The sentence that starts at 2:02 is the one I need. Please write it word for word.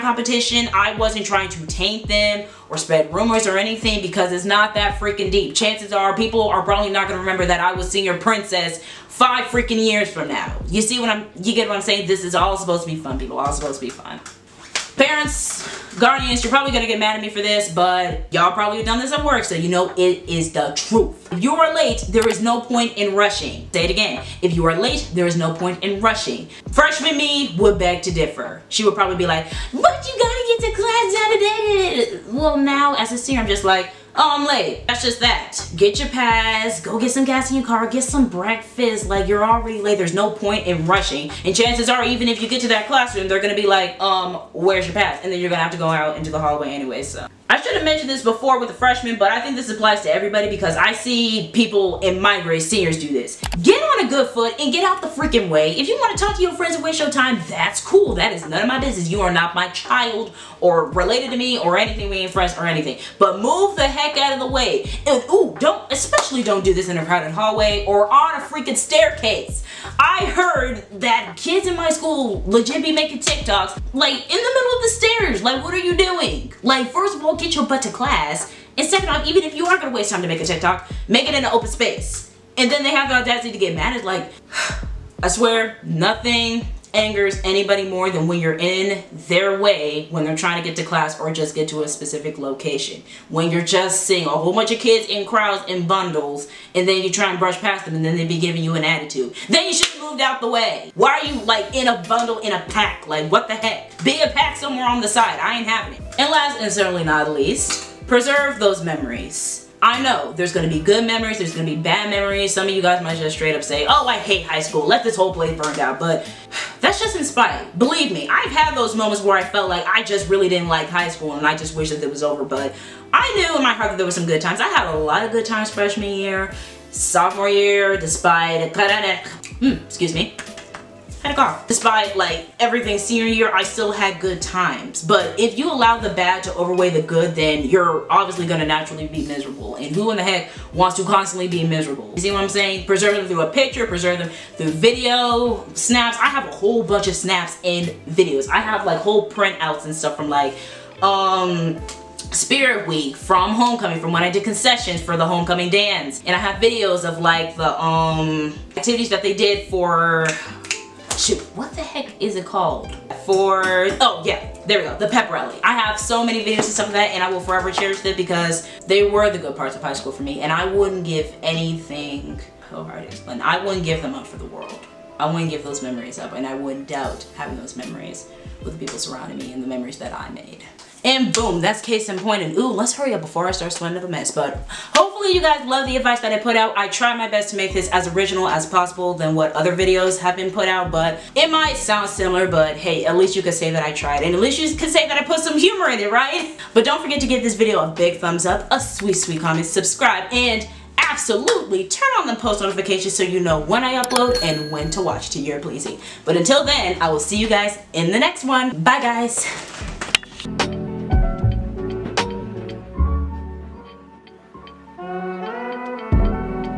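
But I knew in my heart that there were some good times.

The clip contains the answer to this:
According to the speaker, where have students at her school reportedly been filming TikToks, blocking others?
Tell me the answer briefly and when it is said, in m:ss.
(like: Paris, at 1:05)
the stairs, at 1:14.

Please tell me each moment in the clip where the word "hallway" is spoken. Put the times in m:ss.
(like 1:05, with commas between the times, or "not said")
0:46, 1:07.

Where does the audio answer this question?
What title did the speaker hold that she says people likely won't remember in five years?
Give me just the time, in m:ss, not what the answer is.
0:07.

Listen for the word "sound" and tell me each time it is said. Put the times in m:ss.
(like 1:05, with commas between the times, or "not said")
3:11.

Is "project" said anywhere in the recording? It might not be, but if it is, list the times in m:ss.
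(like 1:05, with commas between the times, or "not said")
not said.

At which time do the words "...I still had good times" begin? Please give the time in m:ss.
2:13.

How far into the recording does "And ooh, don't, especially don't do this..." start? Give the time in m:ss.
1:05.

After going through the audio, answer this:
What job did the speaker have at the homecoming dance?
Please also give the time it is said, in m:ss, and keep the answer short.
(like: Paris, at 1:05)
concessions, at 2:34.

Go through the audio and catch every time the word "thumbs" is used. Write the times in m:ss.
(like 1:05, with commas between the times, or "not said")
3:18.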